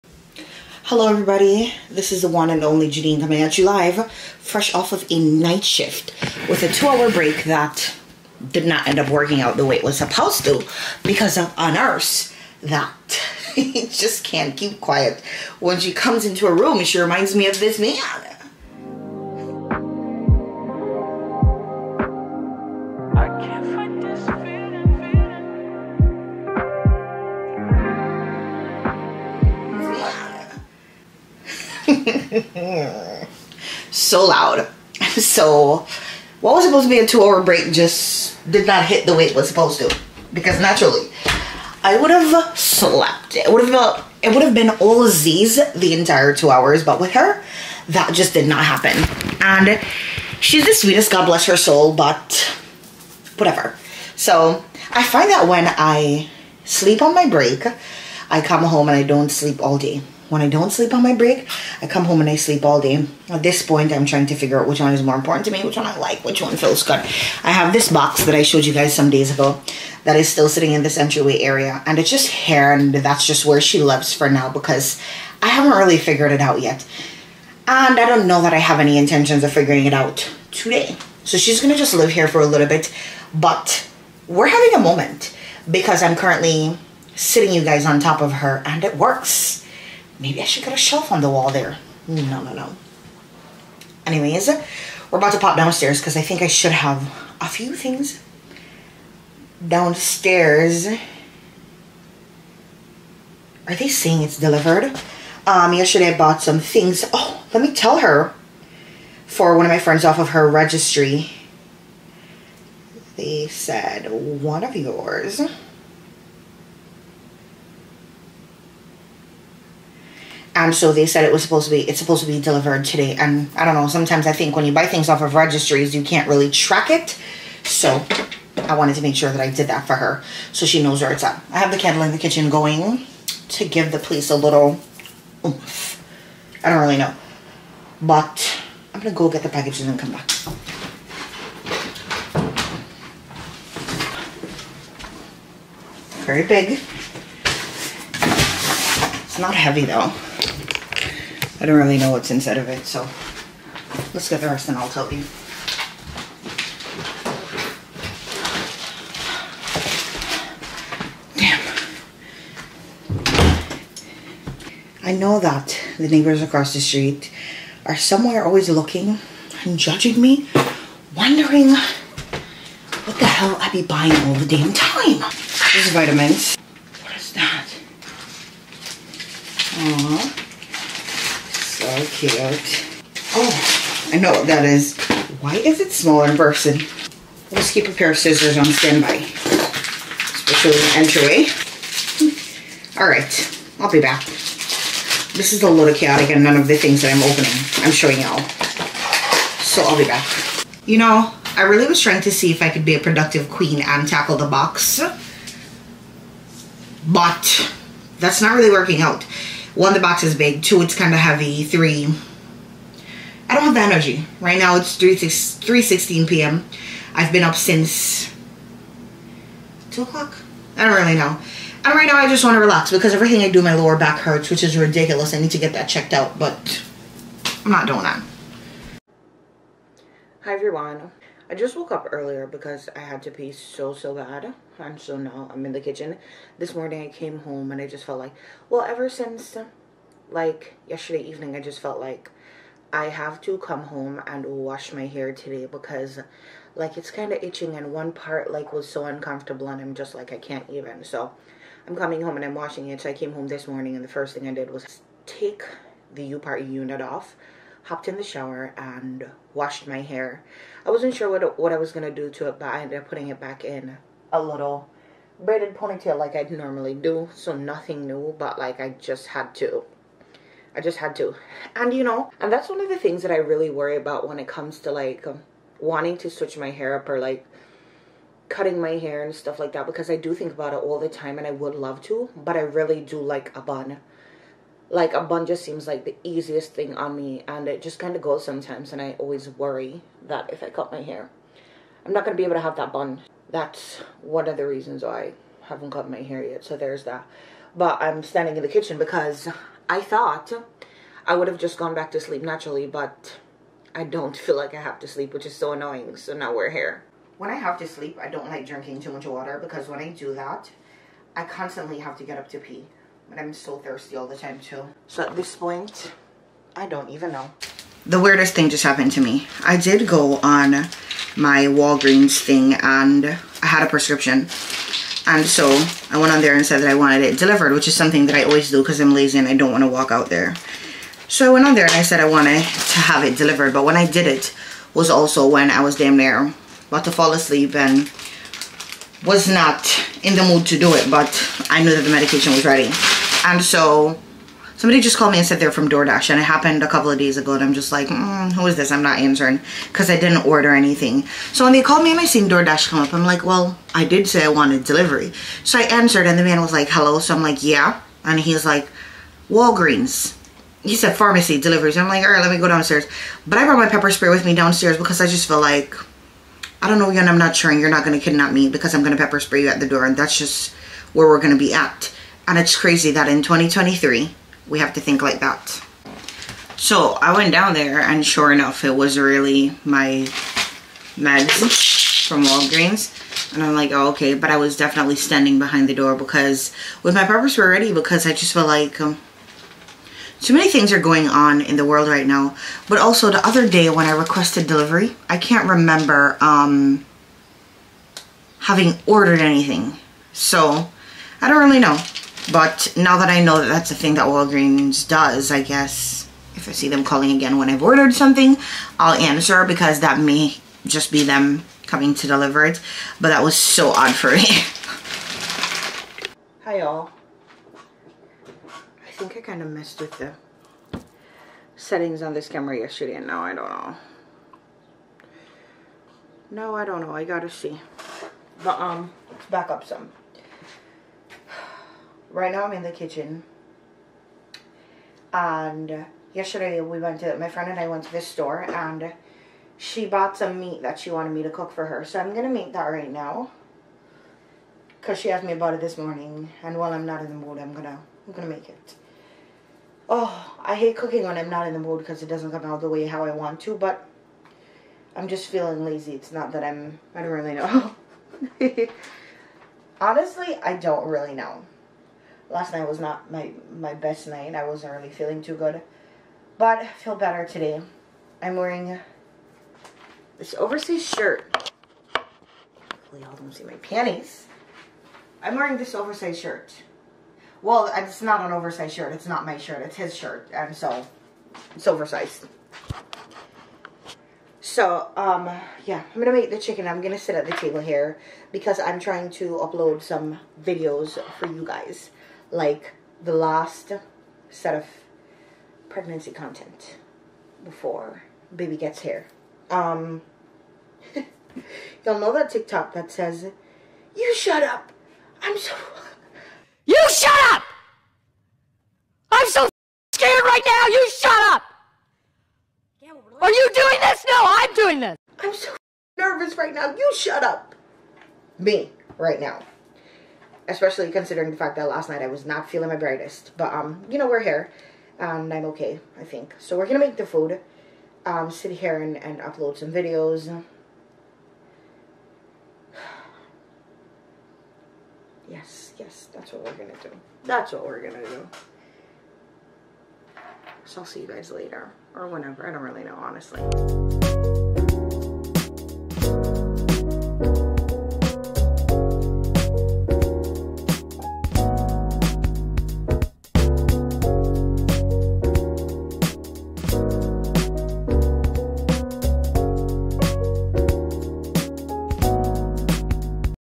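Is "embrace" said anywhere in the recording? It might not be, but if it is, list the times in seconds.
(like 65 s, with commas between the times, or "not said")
not said.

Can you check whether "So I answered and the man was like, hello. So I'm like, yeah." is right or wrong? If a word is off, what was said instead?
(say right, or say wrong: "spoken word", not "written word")
right.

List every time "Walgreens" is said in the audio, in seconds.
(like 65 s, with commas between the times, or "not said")
321 s, 359 s, 382 s, 404 s.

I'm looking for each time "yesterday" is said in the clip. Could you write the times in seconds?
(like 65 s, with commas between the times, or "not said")
105 s, 240 s, 422 s, 436 s.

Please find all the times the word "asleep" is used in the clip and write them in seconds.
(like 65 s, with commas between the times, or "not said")
337 s.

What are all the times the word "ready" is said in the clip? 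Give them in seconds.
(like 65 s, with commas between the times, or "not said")
342 s, 387 s.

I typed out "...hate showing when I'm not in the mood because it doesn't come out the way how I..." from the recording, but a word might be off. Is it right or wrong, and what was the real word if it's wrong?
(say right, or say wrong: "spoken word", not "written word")
wrong: "cooking", not "showing".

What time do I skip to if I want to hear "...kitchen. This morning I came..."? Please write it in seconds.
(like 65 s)
235 s.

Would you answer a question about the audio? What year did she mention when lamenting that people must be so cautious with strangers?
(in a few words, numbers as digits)
2023.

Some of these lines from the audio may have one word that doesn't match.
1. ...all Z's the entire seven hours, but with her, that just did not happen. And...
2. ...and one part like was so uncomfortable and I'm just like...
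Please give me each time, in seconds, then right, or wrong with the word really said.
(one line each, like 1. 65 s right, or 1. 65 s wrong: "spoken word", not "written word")
1. 44 s wrong: "two", not "seven"
2. 247 s right.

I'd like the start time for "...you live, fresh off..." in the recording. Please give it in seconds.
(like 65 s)
3 s.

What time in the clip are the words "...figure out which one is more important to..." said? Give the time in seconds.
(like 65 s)
64 s.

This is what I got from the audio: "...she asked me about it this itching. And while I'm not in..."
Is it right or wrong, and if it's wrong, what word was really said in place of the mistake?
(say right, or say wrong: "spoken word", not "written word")
wrong: "morning", not "itching".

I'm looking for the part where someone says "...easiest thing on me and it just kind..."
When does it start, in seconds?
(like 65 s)
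286 s.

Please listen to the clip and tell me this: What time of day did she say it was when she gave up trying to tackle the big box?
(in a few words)
3:16 p.m.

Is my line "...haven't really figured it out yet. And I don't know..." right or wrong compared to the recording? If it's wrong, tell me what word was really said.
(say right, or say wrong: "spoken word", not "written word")
right.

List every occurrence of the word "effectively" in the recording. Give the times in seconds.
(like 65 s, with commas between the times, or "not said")
not said.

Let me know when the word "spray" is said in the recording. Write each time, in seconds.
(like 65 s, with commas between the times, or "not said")
364 s, 369 s.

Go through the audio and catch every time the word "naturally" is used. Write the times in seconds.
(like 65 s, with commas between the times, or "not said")
40 s, 302 s.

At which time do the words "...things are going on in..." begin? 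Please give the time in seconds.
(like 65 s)
390 s.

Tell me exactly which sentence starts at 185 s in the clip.
Why is it smaller in person?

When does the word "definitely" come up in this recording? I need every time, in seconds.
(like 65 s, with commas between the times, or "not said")
384 s.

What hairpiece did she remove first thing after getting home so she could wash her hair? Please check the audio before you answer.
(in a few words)
U part unit.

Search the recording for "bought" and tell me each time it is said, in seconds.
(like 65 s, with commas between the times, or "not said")
106 s, 440 s.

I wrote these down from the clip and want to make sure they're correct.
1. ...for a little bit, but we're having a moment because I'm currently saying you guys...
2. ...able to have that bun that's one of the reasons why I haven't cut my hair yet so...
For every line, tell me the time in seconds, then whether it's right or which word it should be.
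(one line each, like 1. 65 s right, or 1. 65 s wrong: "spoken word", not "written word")
1. 82 s wrong: "sitting", not "saying"
2. 292 s right.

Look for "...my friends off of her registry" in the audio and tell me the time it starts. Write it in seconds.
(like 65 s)
109 s.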